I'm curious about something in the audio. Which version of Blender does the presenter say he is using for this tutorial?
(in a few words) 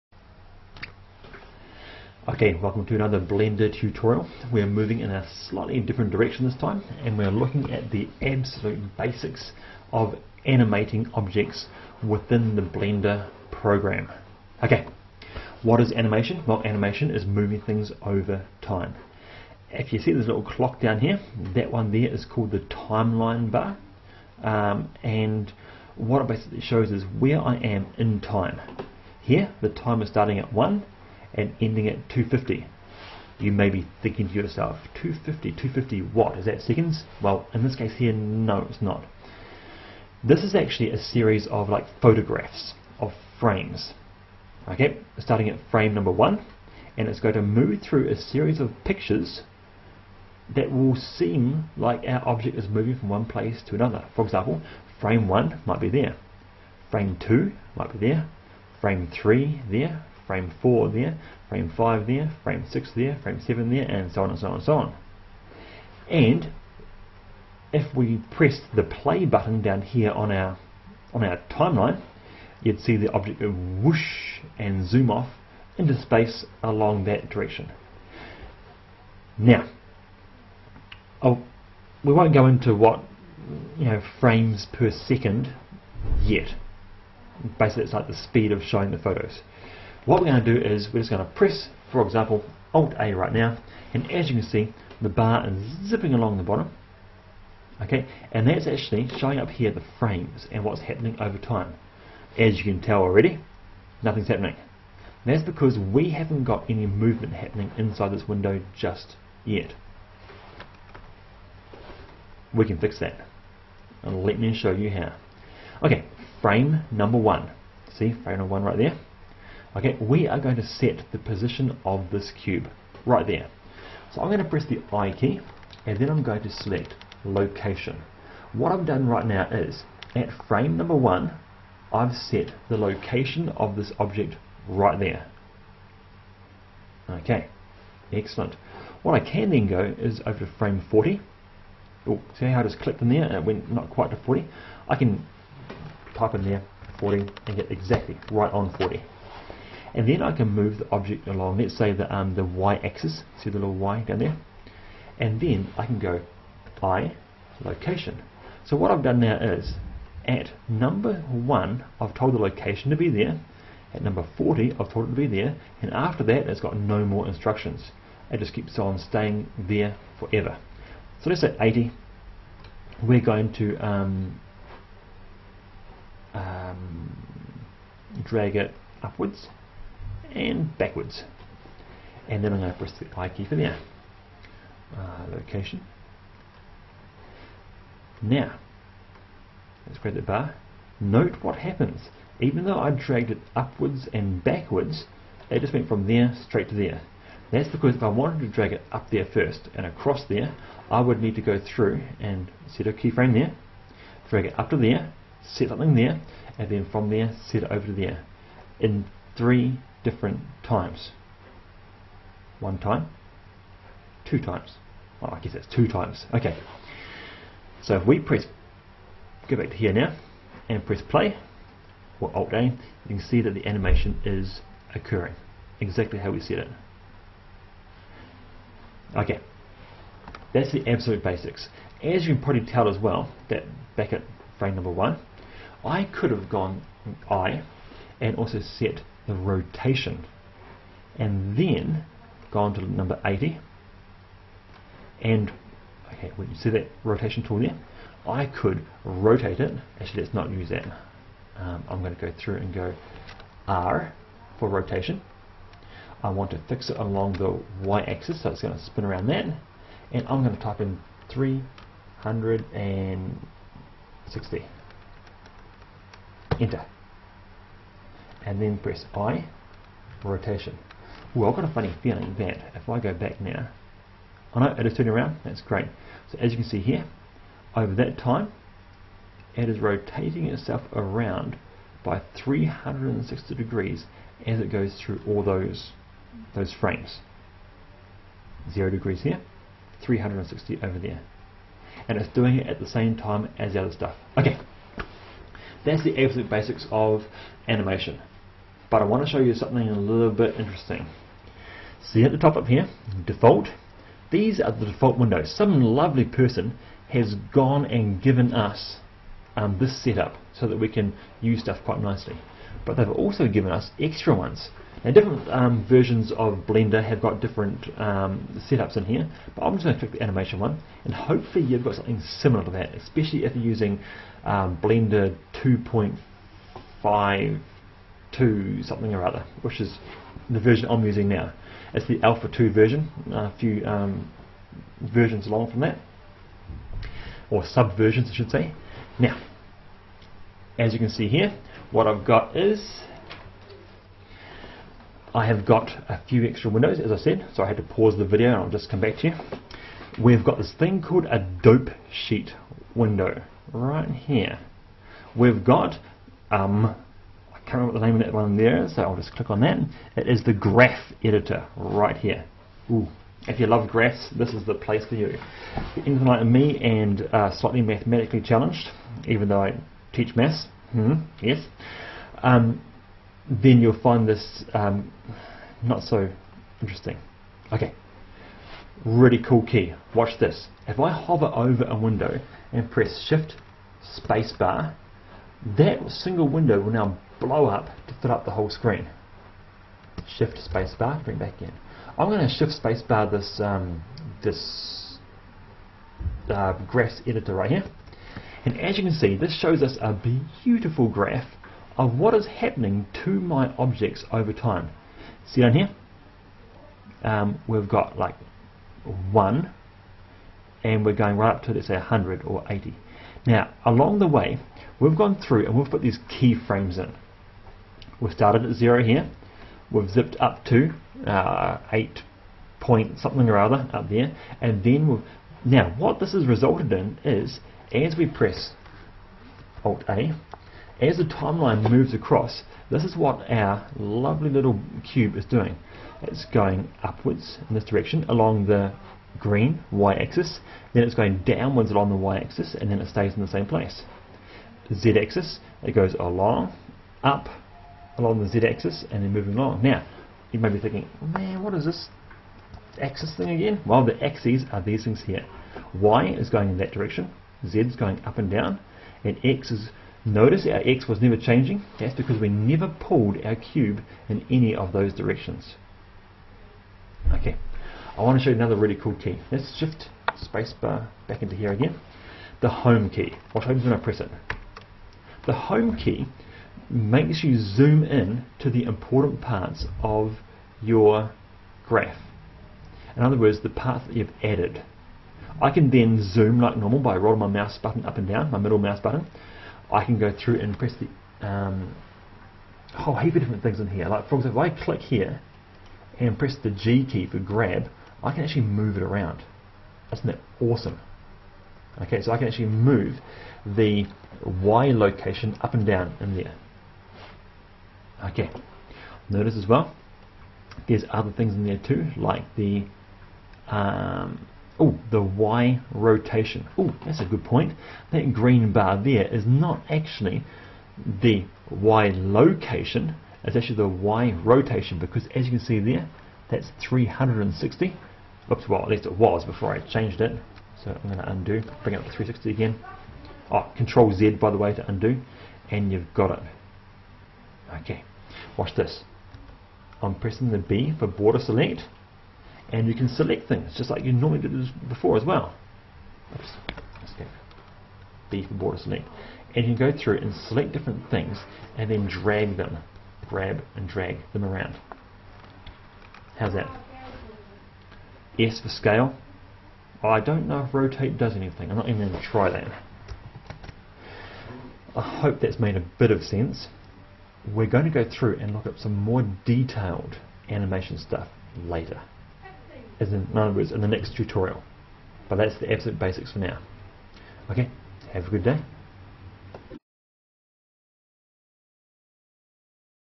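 2.5 Alpha 2.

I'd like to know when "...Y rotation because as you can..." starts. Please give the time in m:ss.
8:43.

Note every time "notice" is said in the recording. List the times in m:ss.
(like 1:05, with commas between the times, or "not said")
7:40, 8:29.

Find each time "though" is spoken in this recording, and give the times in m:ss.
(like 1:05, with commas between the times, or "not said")
3:12, 6:09.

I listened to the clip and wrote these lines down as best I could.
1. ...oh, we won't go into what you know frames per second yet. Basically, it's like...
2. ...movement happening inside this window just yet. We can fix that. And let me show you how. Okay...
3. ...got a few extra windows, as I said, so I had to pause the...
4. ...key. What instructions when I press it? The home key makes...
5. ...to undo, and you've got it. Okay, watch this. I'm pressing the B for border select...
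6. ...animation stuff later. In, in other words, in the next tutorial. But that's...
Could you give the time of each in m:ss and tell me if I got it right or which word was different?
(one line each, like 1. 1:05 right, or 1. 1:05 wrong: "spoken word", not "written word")
1. 1:21 right
2. 1:46 right
3. 5:45 right
4. 7:53 wrong: "happens", not "instructions"
5. 8:54 right
6. 9:30 right.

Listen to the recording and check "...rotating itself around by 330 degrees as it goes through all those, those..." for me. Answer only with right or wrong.
wrong.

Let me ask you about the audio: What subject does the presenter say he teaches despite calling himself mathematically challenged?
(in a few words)
Maths.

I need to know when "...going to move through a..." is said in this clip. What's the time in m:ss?
0:47.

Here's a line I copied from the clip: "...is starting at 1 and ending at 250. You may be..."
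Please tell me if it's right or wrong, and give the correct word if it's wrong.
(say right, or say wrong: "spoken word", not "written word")
right.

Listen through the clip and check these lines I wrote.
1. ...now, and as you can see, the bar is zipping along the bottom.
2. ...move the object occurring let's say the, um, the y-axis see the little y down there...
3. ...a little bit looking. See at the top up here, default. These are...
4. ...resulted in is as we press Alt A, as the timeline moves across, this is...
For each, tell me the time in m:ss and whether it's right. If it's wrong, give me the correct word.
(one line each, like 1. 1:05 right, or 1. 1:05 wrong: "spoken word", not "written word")
1. 1:33 right
2. 2:30 wrong: "along", not "occurring"
3. 4:59 wrong: "interesting", not "looking"
4. 7:06 right.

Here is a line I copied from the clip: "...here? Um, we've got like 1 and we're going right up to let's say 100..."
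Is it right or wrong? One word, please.
right.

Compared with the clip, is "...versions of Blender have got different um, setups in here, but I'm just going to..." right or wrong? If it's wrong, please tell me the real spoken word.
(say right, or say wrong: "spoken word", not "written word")
right.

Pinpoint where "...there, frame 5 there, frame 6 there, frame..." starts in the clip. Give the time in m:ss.
1:00.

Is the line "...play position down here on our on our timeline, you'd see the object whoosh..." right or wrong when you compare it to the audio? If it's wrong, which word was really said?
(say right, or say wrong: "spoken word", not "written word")
wrong: "button", not "position".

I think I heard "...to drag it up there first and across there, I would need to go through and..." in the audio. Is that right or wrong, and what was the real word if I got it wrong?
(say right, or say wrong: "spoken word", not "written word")
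right.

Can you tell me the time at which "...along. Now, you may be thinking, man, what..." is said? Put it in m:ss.
7:29.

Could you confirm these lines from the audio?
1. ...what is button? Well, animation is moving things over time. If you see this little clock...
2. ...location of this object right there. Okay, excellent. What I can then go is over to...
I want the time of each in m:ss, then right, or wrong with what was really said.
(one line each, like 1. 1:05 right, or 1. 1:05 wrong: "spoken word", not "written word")
1. 0:15 wrong: "animation", not "button"
2. 2:12 right.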